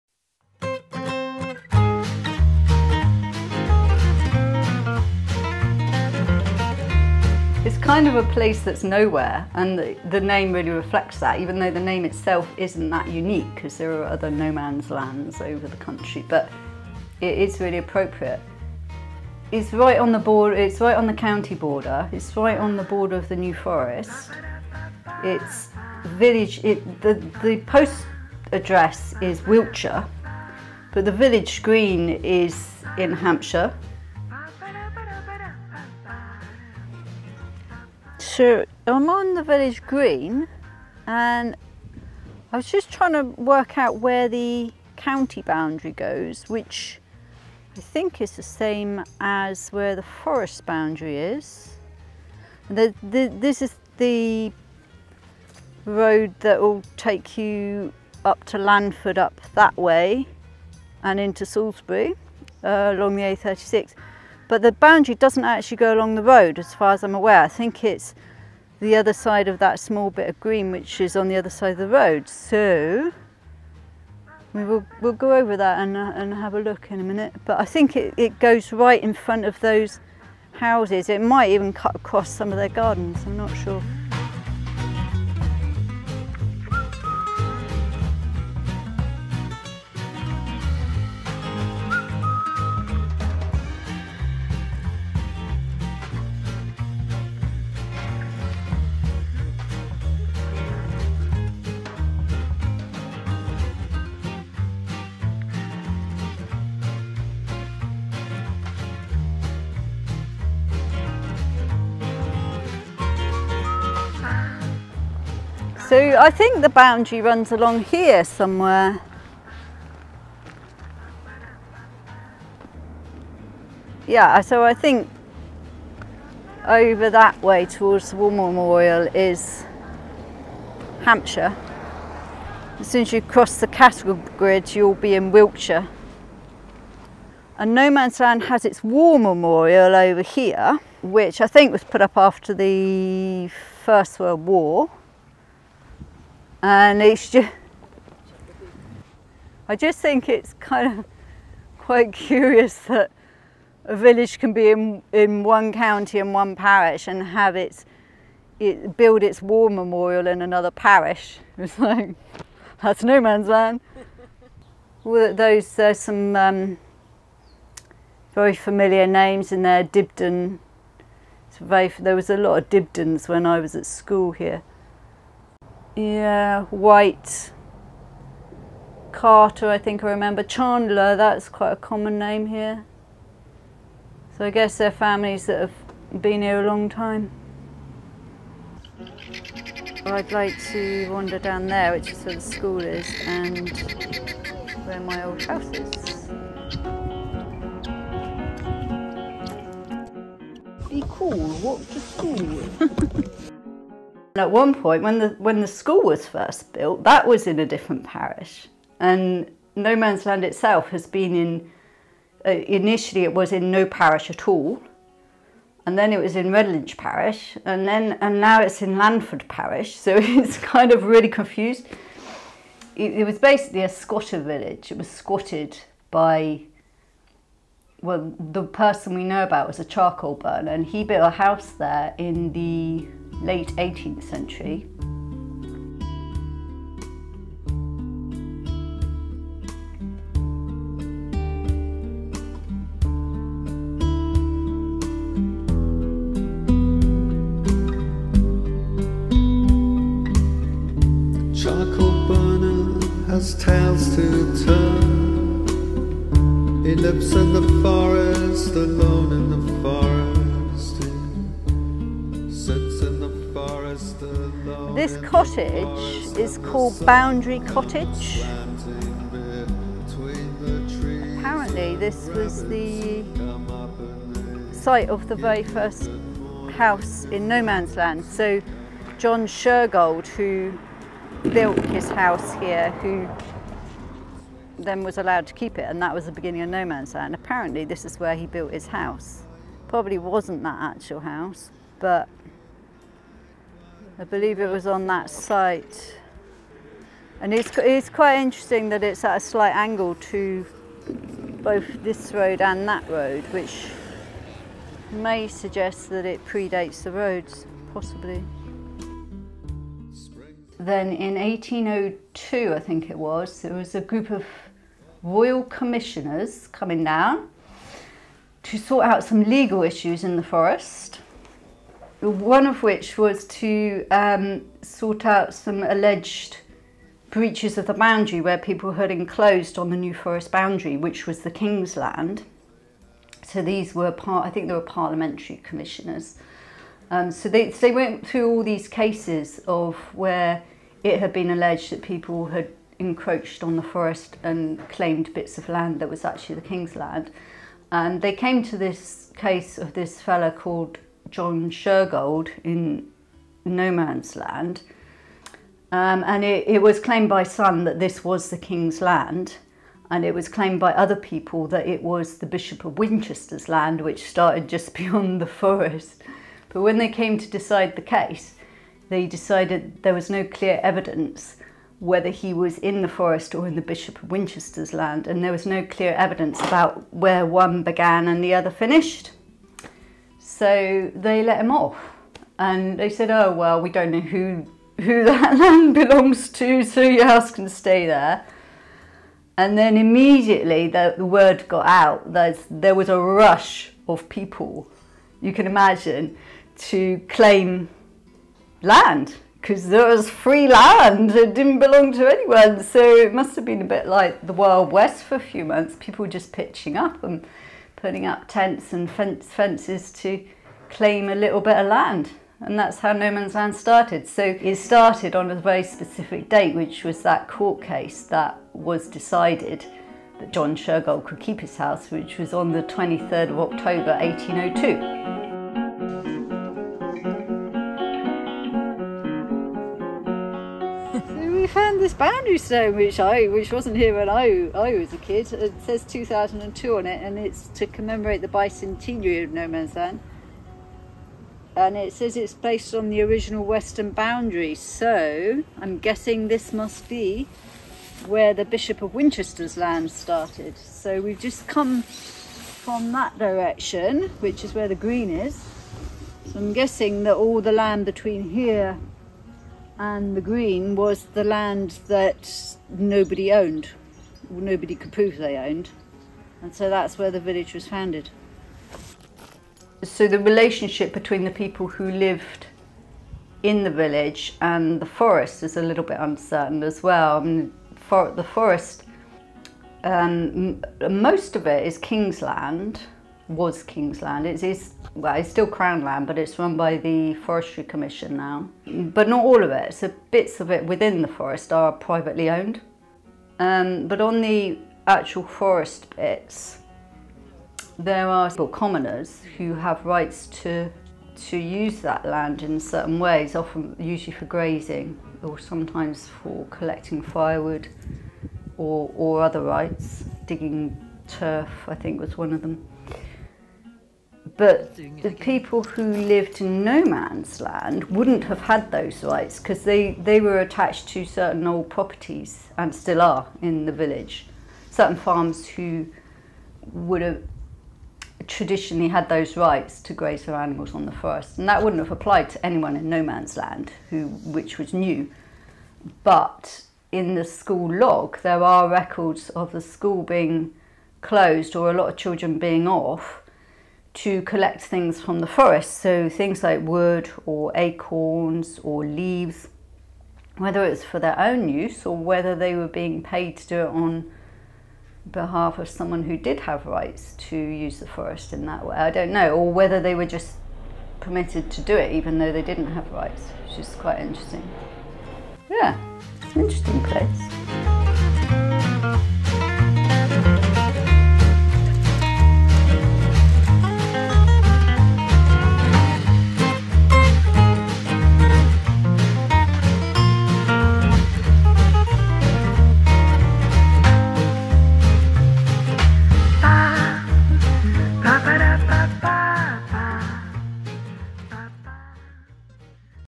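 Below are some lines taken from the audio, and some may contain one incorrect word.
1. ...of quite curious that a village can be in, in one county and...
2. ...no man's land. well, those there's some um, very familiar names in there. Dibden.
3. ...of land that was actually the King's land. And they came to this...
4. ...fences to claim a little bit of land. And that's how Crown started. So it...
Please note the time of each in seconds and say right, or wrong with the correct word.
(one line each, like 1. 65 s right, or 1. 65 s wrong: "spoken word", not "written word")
1. 150 s right
2. 163 s right
3. 345 s right
4. 409 s wrong: "Nomansland", not "Crown".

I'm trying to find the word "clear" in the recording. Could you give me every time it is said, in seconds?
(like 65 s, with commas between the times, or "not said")
370 s, 375 s.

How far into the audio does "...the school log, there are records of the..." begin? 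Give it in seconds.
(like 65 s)
537 s.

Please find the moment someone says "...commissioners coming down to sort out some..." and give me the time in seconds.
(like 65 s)
315 s.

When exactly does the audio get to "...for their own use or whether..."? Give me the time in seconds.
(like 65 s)
551 s.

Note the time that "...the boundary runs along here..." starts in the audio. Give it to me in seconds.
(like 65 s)
116 s.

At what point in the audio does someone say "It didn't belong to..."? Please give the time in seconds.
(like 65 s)
401 s.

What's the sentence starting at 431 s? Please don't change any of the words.
we found this boundary stone, which I, which wasn't here when I, I was a kid.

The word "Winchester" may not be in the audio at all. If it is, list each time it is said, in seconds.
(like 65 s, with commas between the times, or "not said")
362 s, 374 s, 449 s.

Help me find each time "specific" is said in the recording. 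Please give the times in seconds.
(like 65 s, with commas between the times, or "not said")
415 s.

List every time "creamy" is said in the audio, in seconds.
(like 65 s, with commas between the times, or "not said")
not said.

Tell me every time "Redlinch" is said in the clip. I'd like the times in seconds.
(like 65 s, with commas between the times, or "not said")
216 s.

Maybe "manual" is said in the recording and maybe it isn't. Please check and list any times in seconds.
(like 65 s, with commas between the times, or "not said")
not said.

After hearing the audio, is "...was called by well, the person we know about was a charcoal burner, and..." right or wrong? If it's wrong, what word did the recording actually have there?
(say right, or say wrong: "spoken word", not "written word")
wrong: "squatted", not "called".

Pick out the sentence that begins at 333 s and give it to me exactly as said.
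So these were part, I think they were parliamentary commissioners.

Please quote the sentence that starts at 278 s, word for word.
So John Shergold, who built his house here, who then was allowed to keep it, and that was the beginning of Nomansland.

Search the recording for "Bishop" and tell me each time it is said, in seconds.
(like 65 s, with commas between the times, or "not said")
362 s, 373 s, 448 s.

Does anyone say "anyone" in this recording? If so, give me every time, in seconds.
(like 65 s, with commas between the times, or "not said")
402 s, 532 s.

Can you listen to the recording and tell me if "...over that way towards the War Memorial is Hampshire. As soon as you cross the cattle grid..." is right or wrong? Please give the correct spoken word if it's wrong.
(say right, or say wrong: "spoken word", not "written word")
right.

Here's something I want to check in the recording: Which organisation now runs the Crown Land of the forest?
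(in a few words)
Forestry Commission.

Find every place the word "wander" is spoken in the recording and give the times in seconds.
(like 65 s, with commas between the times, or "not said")
191 s.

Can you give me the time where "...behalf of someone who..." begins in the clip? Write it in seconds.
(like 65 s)
555 s.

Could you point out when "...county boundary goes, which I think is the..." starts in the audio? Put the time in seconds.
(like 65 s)
44 s.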